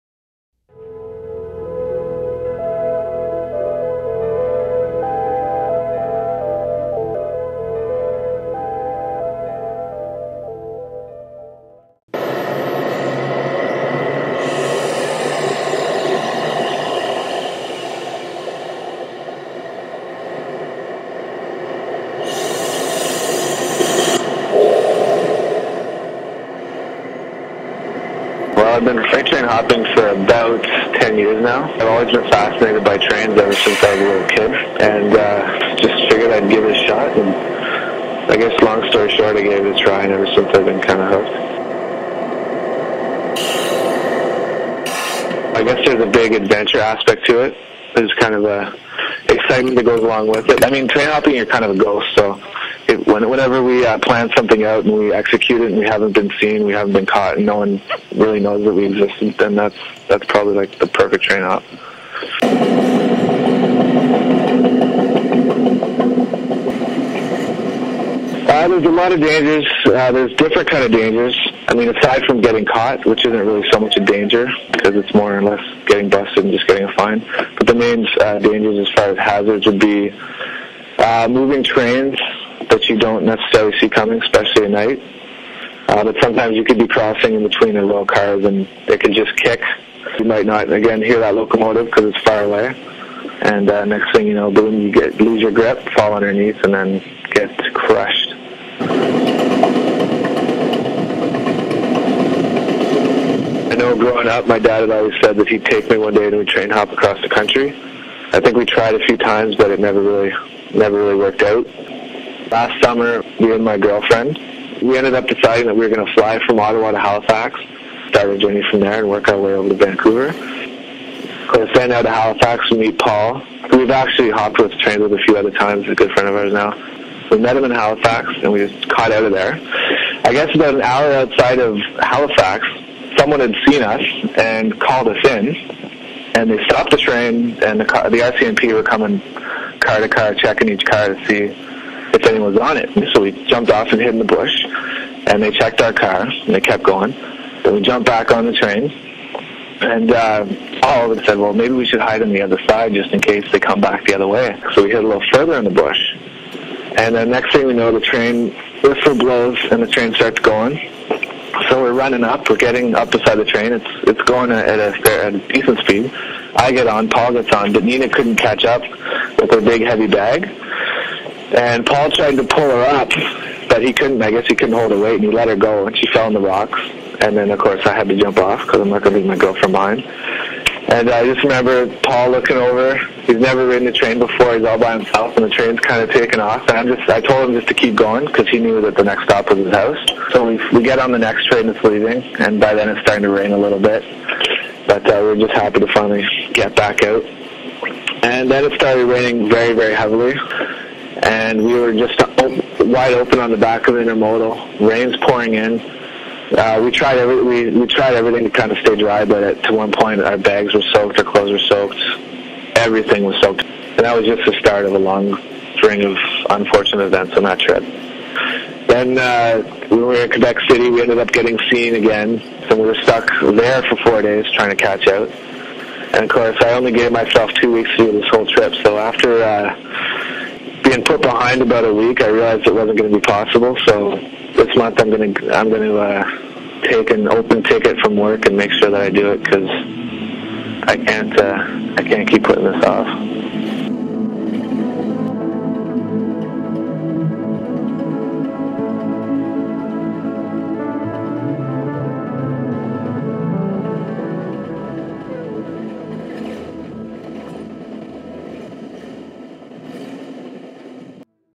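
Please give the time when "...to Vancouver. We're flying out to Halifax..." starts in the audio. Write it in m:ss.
1:59.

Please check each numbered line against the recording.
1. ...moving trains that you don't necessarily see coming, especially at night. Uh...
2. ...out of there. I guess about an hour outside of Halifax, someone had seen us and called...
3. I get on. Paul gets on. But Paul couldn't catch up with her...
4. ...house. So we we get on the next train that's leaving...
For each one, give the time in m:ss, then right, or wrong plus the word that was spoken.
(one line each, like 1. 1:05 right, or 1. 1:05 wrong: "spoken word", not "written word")
1. 1:21 right
2. 2:09 right
3. 2:46 wrong: "Nina", not "Paul"
4. 3:09 right.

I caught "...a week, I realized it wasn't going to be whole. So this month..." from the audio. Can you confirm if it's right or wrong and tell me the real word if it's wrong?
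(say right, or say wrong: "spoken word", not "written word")
wrong: "possible", not "whole".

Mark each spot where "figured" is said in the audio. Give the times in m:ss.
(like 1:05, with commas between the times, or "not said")
0:36.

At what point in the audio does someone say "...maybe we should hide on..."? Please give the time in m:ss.
2:31.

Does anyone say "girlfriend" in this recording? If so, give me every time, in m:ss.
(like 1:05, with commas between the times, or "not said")
1:53, 2:59.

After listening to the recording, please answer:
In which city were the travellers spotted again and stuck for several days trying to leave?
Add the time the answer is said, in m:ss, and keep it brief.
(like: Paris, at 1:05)
Quebec City, at 3:40.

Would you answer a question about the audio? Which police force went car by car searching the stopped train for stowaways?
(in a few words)
RCMP.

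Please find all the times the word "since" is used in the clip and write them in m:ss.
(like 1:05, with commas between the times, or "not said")
0:33, 0:40.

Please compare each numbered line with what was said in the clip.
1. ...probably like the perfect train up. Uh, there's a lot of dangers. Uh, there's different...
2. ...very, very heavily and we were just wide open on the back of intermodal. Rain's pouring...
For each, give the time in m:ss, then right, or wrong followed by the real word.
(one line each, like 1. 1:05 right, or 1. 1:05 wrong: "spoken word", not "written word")
1. 1:00 right
2. 3:19 right.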